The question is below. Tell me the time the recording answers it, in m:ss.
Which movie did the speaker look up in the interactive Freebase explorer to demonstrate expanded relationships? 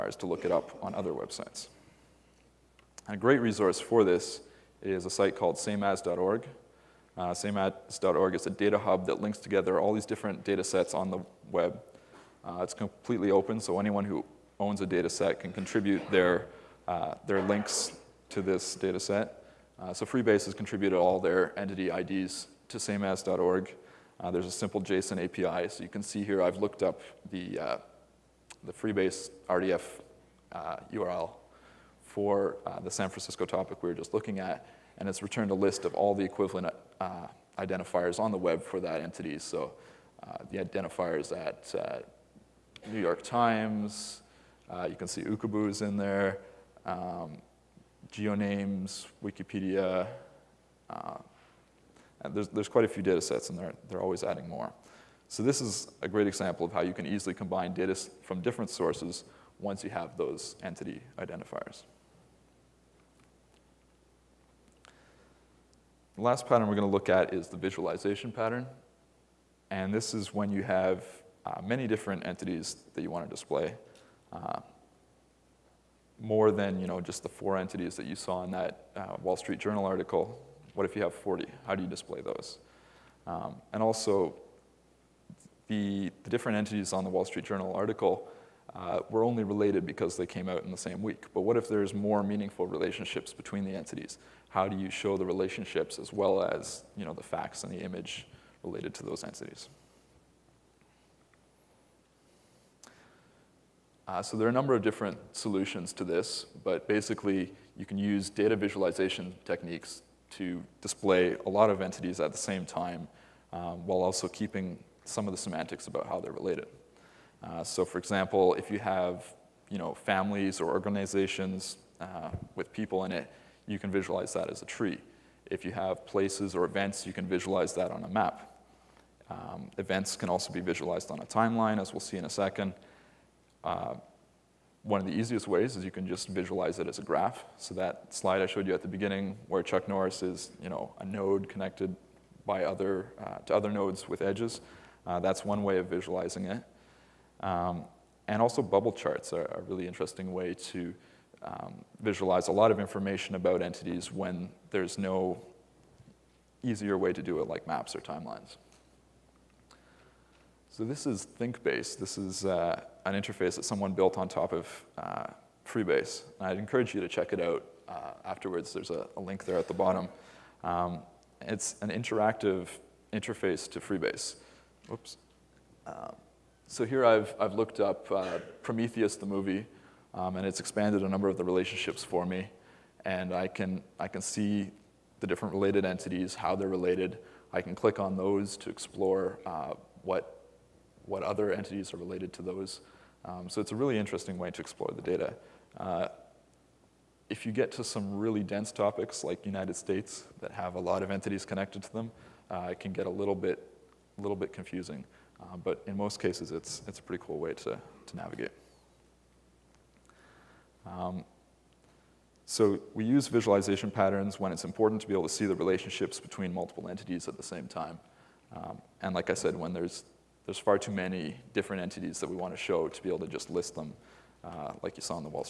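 2:58.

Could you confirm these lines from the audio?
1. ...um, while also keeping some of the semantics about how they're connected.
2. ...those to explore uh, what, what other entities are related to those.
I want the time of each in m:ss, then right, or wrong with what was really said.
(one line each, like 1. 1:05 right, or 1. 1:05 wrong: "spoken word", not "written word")
1. 1:53 wrong: "related", not "connected"
2. 3:08 right.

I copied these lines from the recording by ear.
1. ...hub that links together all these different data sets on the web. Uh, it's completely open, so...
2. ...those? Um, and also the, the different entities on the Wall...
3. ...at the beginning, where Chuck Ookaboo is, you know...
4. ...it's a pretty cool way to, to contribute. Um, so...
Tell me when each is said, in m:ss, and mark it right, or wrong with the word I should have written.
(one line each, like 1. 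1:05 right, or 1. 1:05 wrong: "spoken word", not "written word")
1. 0:08 right
2. 1:22 right
3. 2:18 wrong: "Norris", not "Ookaboo"
4. 3:26 wrong: "navigate", not "contribute".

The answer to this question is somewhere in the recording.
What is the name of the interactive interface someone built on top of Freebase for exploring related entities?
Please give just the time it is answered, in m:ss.
2:41.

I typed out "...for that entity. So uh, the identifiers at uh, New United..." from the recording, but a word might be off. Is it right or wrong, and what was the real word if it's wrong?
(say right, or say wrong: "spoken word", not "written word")
wrong: "York", not "United".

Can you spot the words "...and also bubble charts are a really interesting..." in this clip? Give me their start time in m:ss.
2:28.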